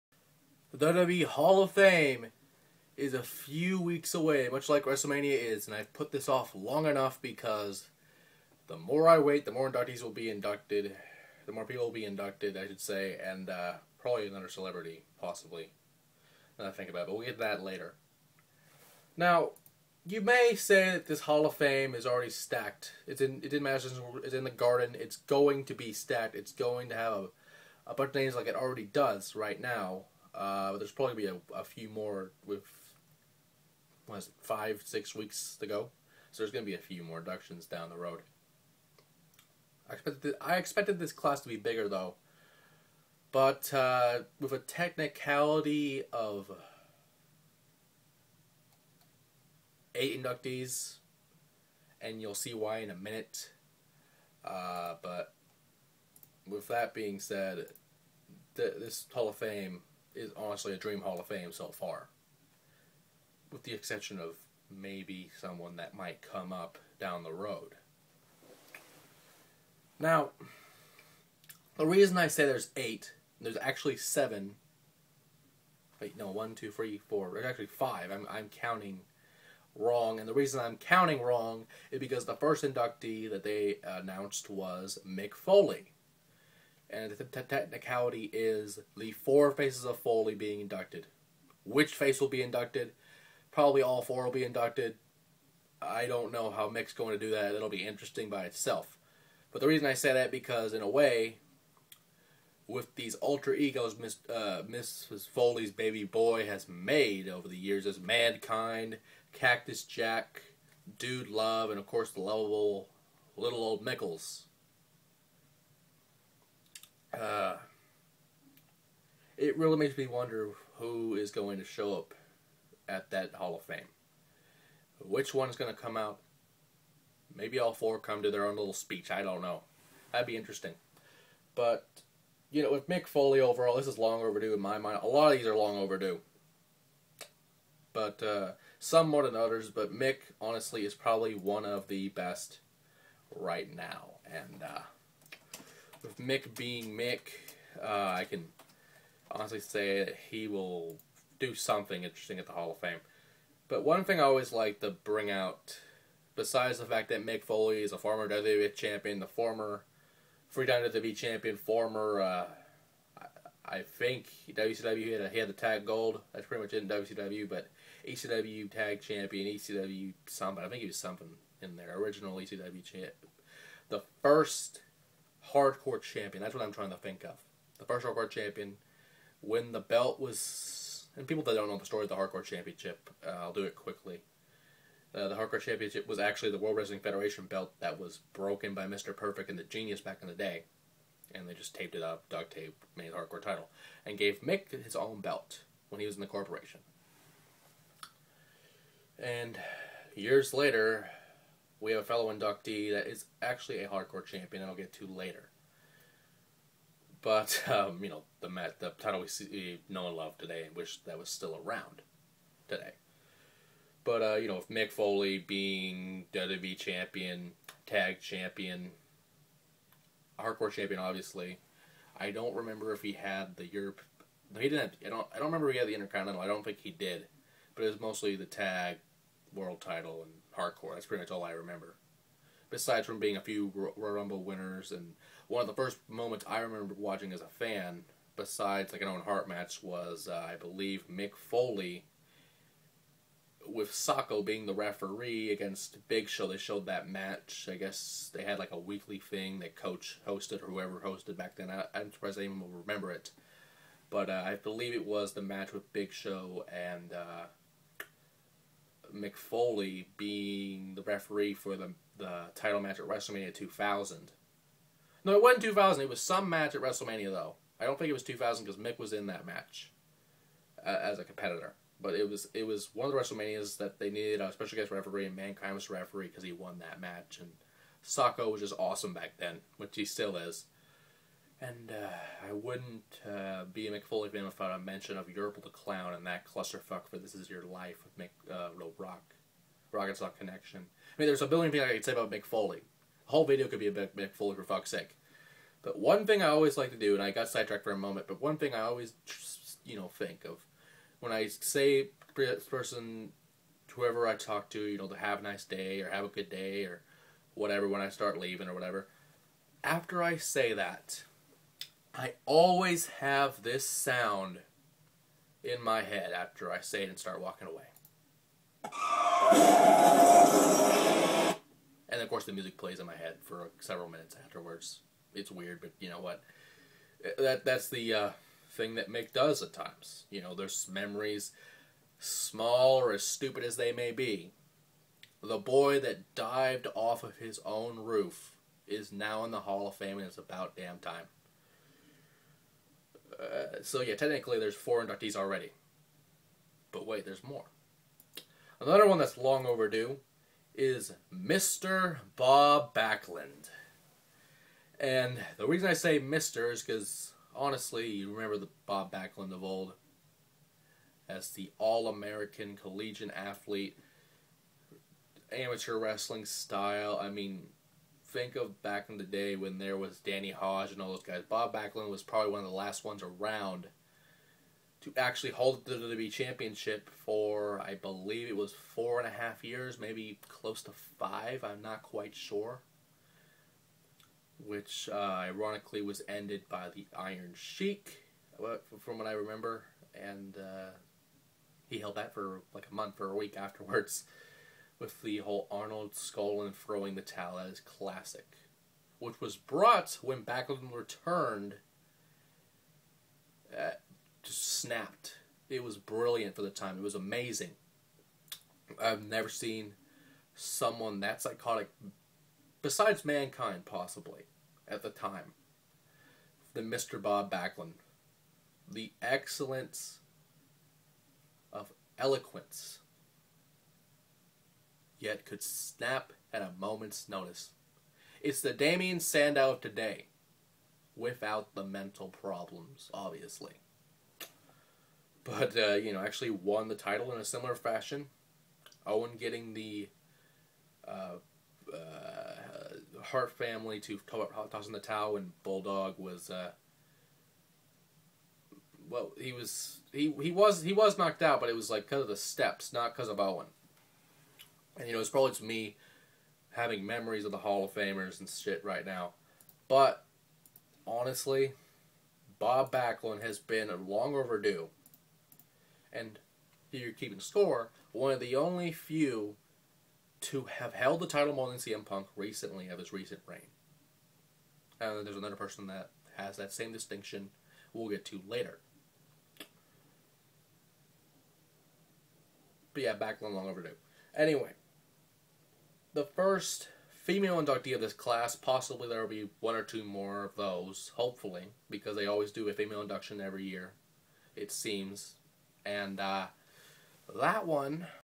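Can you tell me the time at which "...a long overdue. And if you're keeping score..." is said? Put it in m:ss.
7:43.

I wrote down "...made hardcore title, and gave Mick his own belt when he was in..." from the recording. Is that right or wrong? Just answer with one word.
right.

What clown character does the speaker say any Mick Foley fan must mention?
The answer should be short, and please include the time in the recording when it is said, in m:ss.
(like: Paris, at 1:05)
Yurple the Clown, at 4:45.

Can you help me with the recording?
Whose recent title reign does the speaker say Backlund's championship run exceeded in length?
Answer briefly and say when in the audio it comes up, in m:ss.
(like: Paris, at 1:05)
CM Punk, at 7:51.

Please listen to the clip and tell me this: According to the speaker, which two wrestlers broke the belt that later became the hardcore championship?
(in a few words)
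Mr. Perfect and the Genius.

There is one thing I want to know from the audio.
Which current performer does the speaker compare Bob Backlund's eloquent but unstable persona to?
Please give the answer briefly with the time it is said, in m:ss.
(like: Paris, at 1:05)
Damien Sandow, at 7:08.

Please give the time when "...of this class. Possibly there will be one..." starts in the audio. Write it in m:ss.
8:07.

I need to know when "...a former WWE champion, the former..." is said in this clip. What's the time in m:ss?
2:37.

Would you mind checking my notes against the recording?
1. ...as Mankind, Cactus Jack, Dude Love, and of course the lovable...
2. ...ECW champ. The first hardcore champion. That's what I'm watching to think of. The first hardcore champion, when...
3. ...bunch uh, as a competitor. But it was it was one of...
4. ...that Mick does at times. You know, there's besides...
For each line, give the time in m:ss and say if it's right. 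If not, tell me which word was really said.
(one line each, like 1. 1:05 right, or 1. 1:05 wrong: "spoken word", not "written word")
1. 1:47 right
2. 2:52 wrong: "trying", not "watching"
3. 4:29 wrong: "match", not "bunch"
4. 5:28 wrong: "memories", not "besides".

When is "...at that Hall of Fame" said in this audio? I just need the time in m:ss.
2:02.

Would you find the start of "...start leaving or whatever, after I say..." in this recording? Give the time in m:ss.
5:08.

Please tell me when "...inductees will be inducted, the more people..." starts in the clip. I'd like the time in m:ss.
0:09.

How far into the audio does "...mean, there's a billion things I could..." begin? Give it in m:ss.
4:51.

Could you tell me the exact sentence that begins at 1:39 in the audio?
But the reason I say that because in a way, with these alter egos, Miss uh, Mrs.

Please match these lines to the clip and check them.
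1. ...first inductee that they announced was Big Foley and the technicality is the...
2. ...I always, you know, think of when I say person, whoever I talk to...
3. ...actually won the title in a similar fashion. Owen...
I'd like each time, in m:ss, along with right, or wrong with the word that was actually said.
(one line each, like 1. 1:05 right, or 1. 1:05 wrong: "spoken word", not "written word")
1. 1:22 wrong: "Mick", not "Big"
2. 4:58 right
3. 7:16 right.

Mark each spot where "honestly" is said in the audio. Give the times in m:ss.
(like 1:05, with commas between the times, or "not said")
1:00, 2:20, 2:29, 5:57, 7:41.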